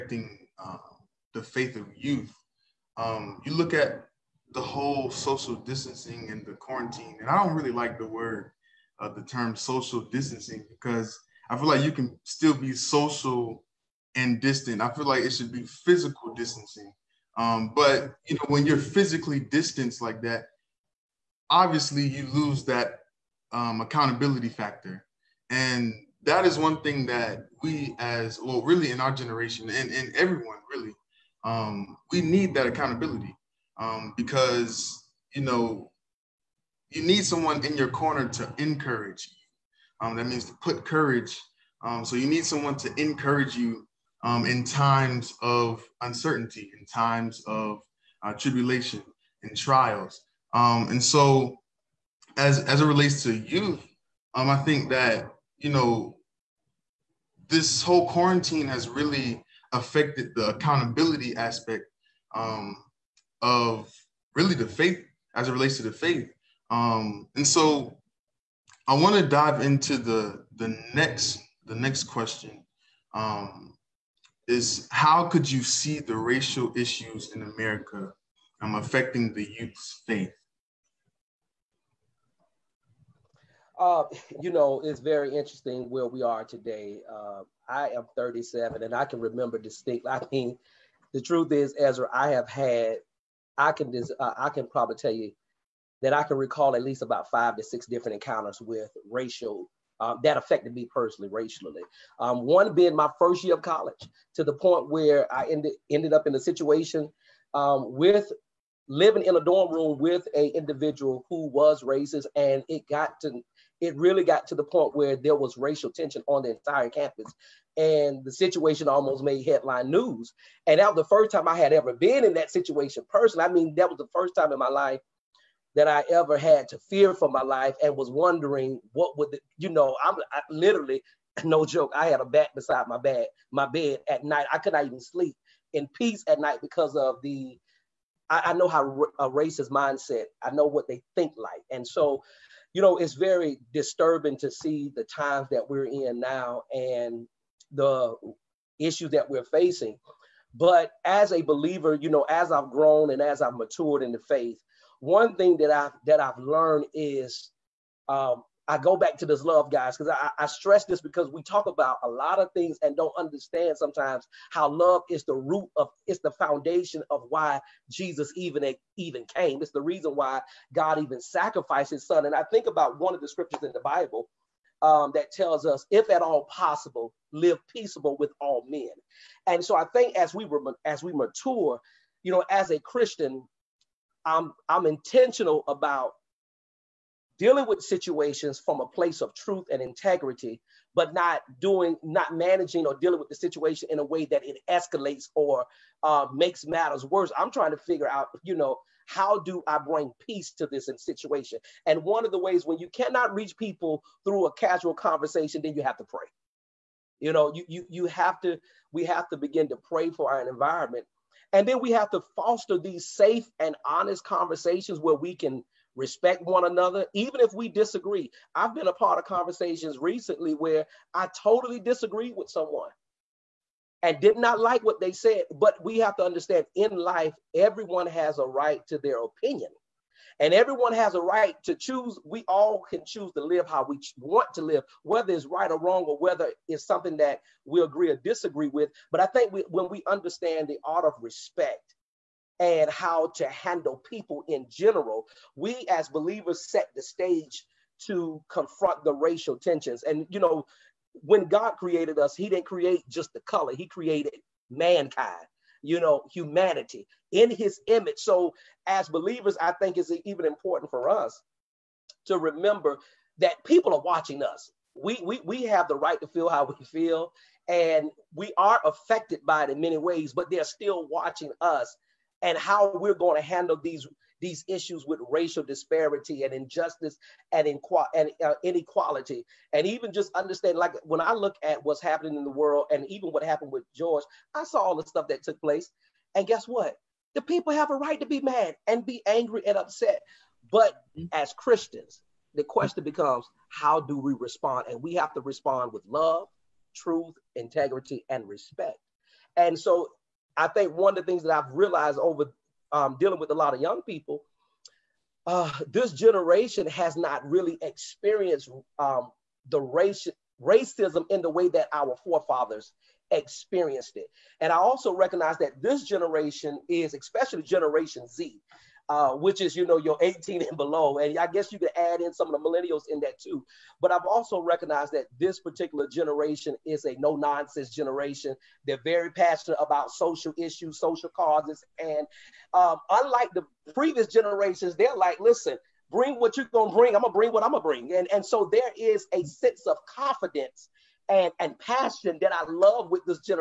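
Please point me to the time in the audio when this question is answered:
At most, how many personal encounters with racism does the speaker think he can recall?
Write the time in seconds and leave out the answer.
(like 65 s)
97 s.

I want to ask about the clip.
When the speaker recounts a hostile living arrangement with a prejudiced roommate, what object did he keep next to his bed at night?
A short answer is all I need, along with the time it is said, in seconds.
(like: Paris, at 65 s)
A bat, at 132 s.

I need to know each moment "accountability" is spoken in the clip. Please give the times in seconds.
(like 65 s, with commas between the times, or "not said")
23 s, 32 s, 60 s.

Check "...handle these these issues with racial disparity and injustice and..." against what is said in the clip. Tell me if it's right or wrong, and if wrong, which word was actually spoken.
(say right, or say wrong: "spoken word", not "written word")
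right.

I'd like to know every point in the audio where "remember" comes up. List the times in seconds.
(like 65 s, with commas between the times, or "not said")
89 s, 262 s.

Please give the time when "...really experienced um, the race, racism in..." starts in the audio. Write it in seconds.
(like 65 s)
307 s.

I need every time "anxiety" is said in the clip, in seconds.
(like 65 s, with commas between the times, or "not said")
not said.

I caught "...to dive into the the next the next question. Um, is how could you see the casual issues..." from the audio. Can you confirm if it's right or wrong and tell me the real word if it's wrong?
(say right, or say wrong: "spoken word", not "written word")
wrong: "racial", not "casual".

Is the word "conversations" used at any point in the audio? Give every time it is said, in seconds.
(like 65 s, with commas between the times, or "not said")
204 s, 214 s, 219 s.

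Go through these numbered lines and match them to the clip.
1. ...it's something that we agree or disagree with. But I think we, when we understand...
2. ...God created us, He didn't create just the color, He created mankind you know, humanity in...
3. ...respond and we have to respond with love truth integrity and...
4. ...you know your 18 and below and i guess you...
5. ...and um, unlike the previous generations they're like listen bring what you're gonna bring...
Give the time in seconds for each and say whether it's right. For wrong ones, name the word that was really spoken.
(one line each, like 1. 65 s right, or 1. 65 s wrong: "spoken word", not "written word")
1. 236 s right
2. 251 s right
3. 294 s right
4. 319 s right
5. 331 s right.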